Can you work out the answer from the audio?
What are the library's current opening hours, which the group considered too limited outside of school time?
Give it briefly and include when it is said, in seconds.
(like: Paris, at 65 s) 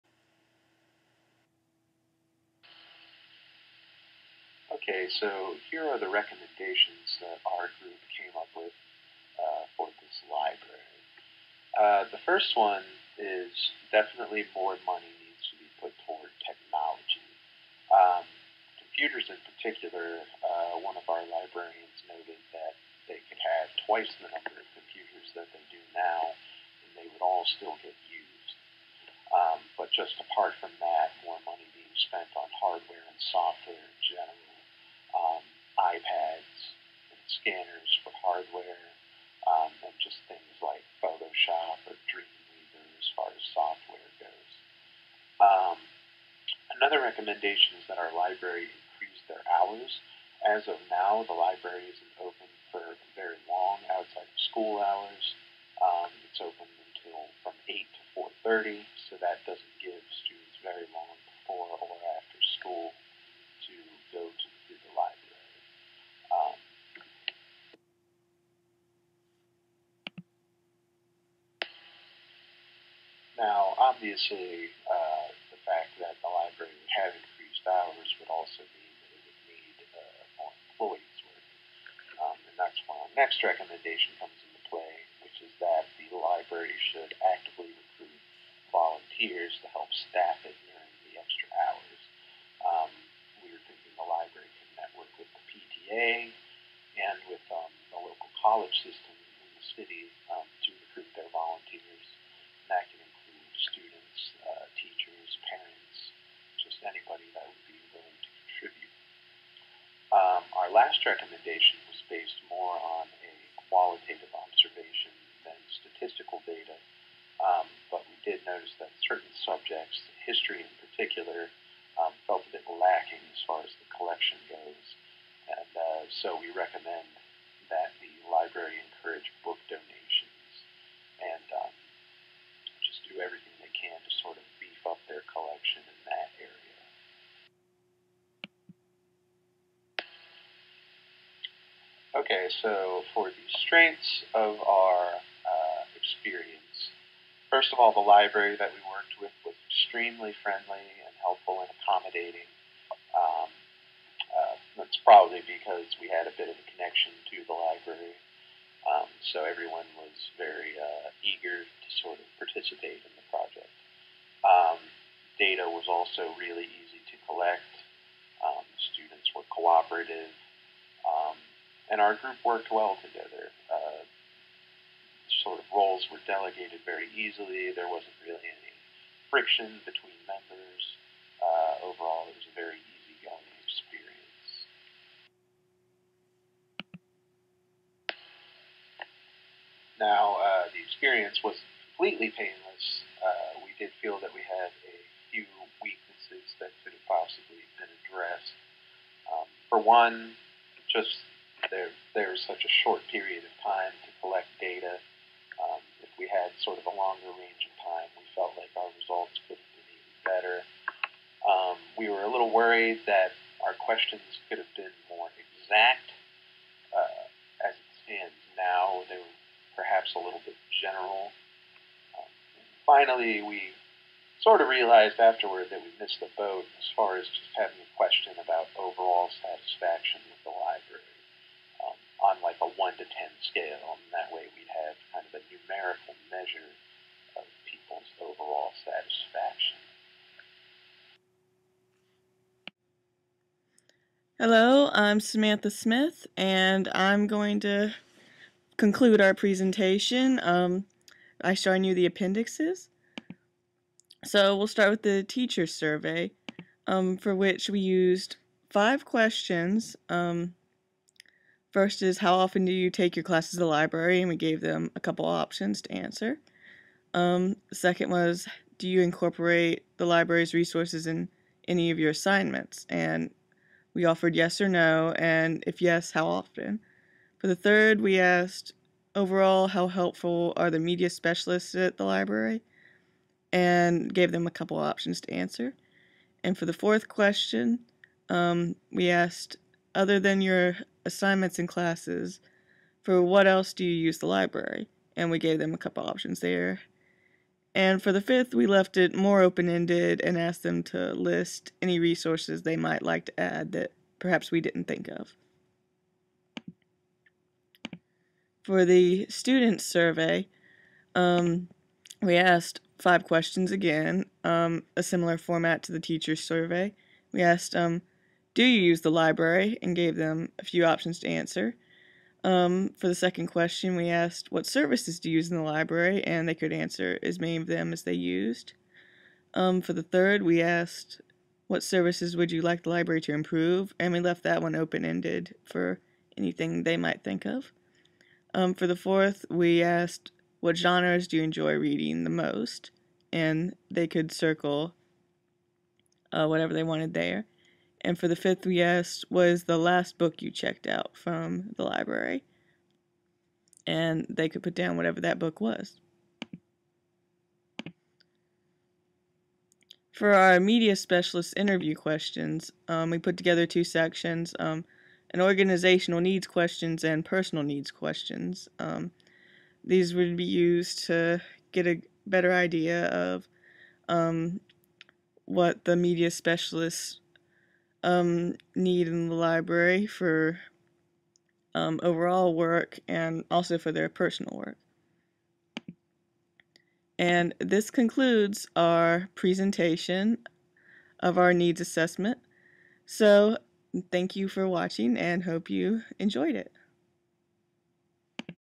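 8 to 4:30, at 57 s.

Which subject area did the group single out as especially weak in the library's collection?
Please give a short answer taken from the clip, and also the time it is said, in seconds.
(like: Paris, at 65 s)
history, at 120 s.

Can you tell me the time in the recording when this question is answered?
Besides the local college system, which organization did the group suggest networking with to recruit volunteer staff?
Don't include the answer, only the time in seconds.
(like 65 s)
95 s.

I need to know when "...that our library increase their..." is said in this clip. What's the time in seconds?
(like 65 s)
47 s.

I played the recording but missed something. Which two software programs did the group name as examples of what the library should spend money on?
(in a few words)
Photoshop or Dreamweaver.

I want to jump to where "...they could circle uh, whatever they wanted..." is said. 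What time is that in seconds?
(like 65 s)
343 s.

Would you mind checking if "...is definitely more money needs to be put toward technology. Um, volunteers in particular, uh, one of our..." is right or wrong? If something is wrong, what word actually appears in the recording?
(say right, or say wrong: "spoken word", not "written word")
wrong: "computers", not "volunteers".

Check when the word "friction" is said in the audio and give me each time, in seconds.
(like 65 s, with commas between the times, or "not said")
179 s.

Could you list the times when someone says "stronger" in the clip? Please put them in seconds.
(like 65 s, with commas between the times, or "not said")
not said.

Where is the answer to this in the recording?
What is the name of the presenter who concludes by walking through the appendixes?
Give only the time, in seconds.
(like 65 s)
245 s.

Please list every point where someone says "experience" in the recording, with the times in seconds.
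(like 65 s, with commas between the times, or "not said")
145 s, 183 s, 190 s.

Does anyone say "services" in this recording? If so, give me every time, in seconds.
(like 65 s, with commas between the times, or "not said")
324 s, 331 s.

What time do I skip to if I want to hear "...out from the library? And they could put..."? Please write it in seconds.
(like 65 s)
350 s.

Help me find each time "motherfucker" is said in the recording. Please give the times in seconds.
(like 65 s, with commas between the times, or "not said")
not said.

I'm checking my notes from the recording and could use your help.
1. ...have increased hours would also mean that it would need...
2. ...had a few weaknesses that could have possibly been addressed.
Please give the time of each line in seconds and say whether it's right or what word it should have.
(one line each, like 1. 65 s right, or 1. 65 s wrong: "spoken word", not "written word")
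1. 76 s right
2. 194 s right.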